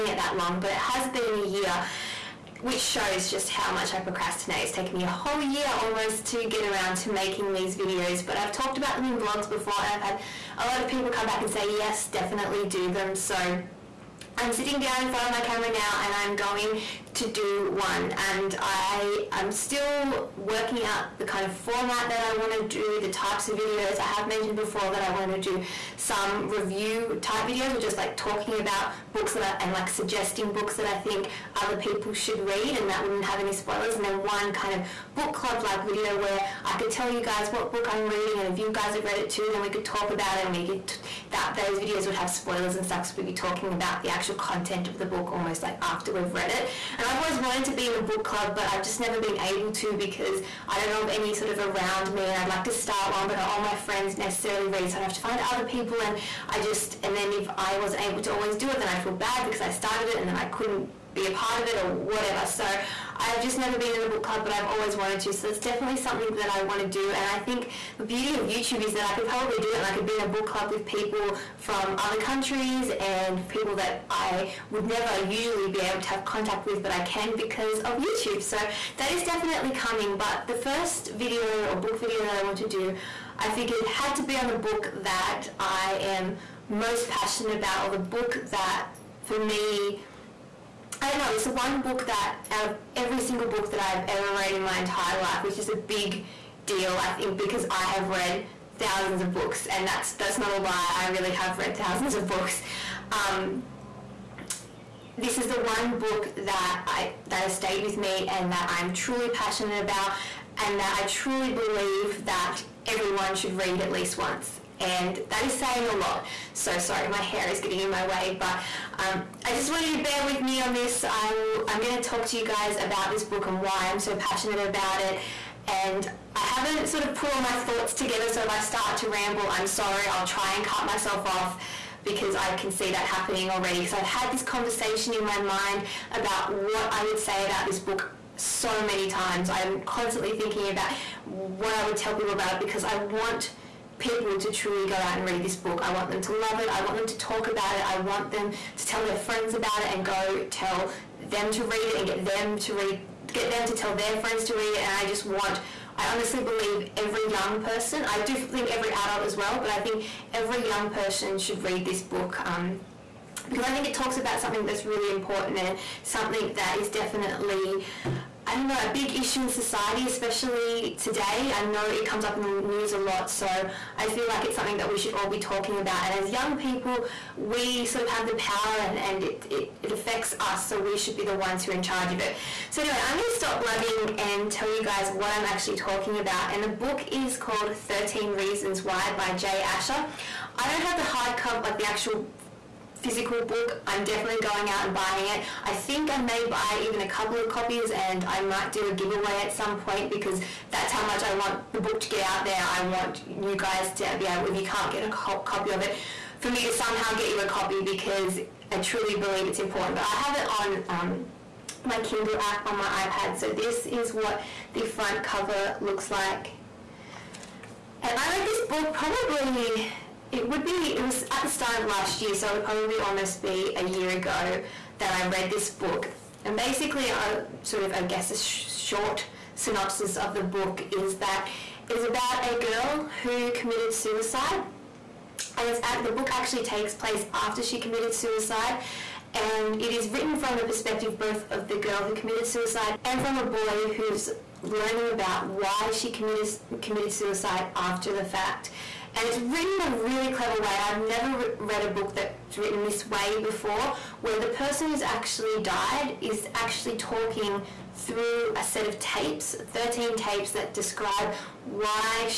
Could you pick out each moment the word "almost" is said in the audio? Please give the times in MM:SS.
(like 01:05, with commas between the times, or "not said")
00:05, 00:45, 03:42.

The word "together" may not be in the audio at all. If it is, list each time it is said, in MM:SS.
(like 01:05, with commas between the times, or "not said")
02:07.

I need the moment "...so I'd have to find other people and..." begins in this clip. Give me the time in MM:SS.
00:54.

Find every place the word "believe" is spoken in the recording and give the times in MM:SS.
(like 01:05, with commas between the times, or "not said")
01:51, 02:36, 03:29.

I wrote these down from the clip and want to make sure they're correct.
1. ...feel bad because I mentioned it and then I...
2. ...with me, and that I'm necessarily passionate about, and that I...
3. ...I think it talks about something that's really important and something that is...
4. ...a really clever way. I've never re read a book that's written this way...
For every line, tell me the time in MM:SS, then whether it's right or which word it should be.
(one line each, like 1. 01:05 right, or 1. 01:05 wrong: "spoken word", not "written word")
1. 00:59 wrong: "started", not "mentioned"
2. 01:47 wrong: "truly", not "necessarily"
3. 02:43 right
4. 04:09 right.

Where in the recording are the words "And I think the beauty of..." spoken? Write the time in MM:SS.
01:07.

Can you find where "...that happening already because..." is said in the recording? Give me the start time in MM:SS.
02:12.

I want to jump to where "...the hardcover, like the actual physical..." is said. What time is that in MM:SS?
03:10.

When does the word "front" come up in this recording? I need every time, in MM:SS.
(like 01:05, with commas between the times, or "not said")
00:15, 03:34.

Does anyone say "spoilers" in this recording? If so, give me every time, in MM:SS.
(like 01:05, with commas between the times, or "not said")
00:33, 00:42.